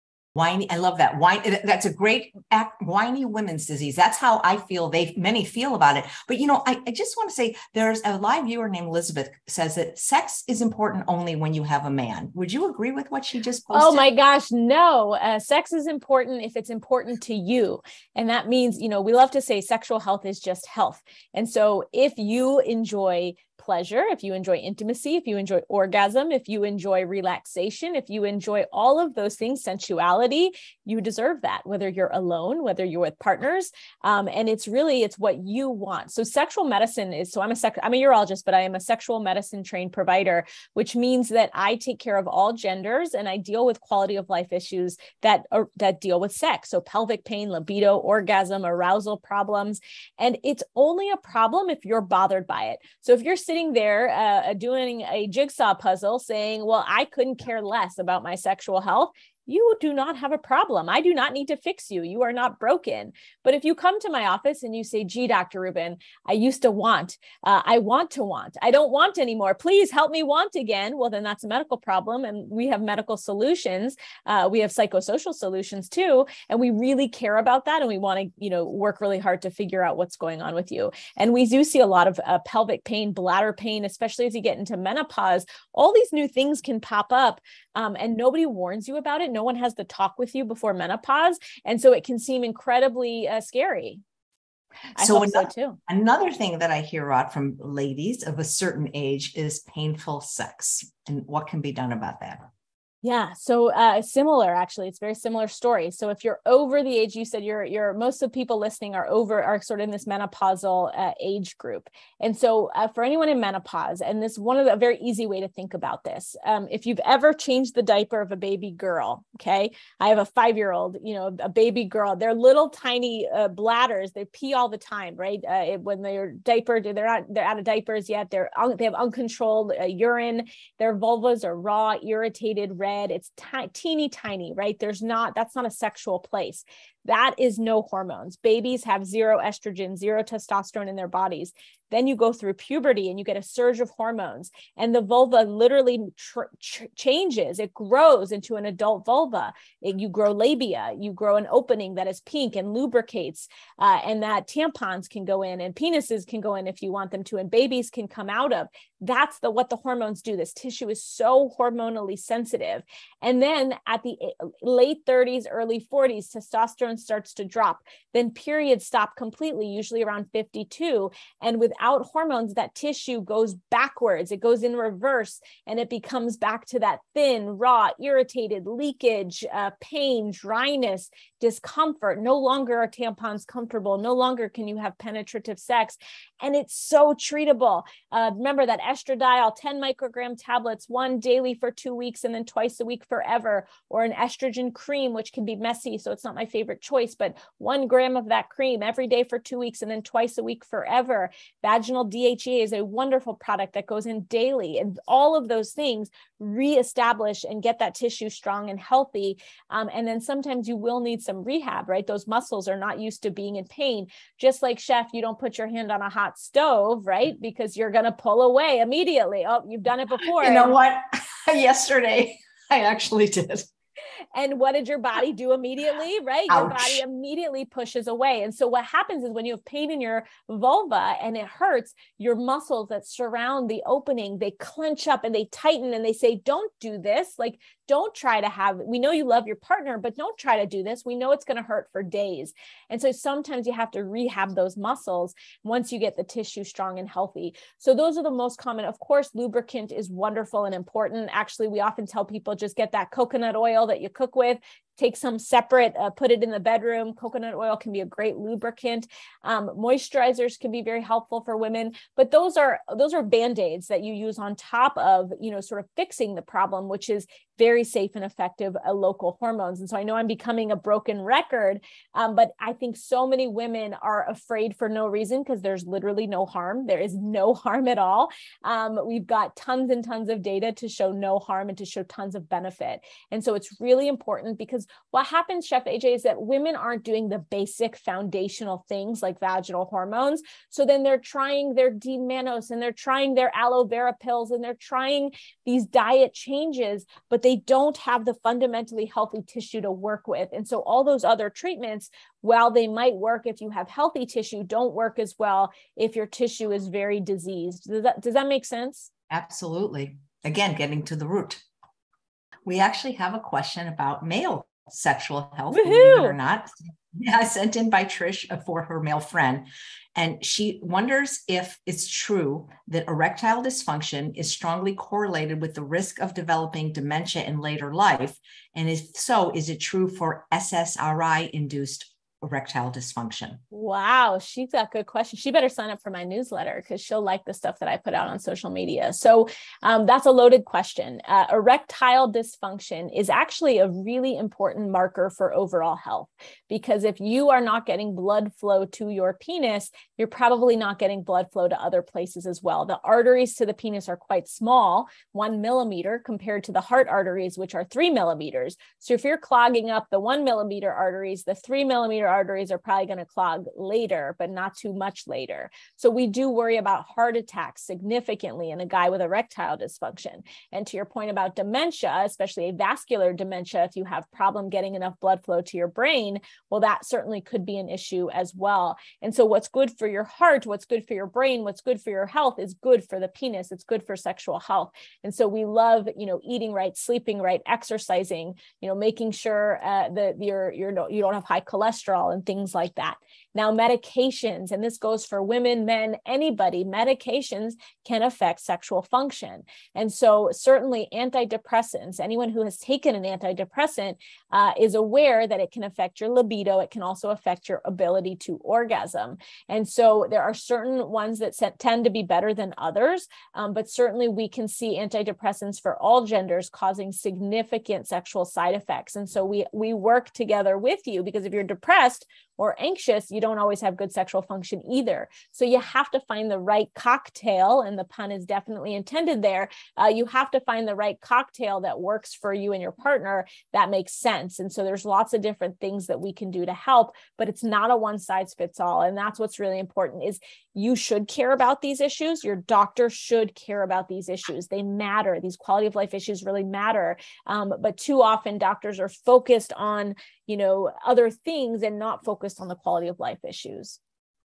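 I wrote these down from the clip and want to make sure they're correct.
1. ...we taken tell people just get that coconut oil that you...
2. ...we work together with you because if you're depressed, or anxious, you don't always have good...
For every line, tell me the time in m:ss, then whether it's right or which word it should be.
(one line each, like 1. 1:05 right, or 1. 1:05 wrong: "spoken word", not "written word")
1. 4:11 wrong: "often", not "taken"
2. 6:59 right.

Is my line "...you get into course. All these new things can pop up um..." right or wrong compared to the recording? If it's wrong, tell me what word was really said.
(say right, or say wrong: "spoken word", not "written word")
wrong: "menopause", not "course".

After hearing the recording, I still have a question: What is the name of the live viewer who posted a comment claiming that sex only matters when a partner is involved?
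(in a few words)
Elizabeth.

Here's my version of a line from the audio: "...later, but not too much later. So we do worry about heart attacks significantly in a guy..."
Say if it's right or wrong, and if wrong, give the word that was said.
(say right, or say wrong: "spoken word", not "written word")
right.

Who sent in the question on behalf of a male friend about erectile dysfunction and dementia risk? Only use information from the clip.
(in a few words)
Trish.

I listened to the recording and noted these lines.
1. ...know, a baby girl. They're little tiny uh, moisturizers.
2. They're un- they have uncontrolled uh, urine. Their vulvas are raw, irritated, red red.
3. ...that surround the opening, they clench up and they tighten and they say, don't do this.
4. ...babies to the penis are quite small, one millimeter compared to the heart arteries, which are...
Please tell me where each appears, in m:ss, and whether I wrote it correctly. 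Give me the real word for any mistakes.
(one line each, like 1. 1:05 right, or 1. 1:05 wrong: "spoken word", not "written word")
1. 2:01 wrong: "bladders", not "moisturizers"
2. 2:08 right
3. 3:52 right
4. 5:53 wrong: "arteries", not "babies".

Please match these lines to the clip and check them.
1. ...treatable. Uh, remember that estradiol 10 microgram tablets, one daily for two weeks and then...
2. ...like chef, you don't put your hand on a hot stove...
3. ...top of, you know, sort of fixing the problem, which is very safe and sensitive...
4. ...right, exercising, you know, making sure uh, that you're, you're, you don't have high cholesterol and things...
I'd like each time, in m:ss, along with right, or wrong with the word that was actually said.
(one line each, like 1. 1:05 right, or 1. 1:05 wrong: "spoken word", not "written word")
1. 3:07 right
2. 3:34 right
3. 4:24 wrong: "effective", not "sensitive"
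4. 6:27 right.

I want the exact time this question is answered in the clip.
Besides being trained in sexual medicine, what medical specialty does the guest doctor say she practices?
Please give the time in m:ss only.
0:38.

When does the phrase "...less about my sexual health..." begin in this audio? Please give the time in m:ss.
0:57.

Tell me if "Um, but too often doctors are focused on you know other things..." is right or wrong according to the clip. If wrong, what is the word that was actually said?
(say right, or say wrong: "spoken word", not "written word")
right.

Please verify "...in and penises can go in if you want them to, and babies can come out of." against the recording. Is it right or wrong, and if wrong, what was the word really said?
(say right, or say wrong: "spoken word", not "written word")
right.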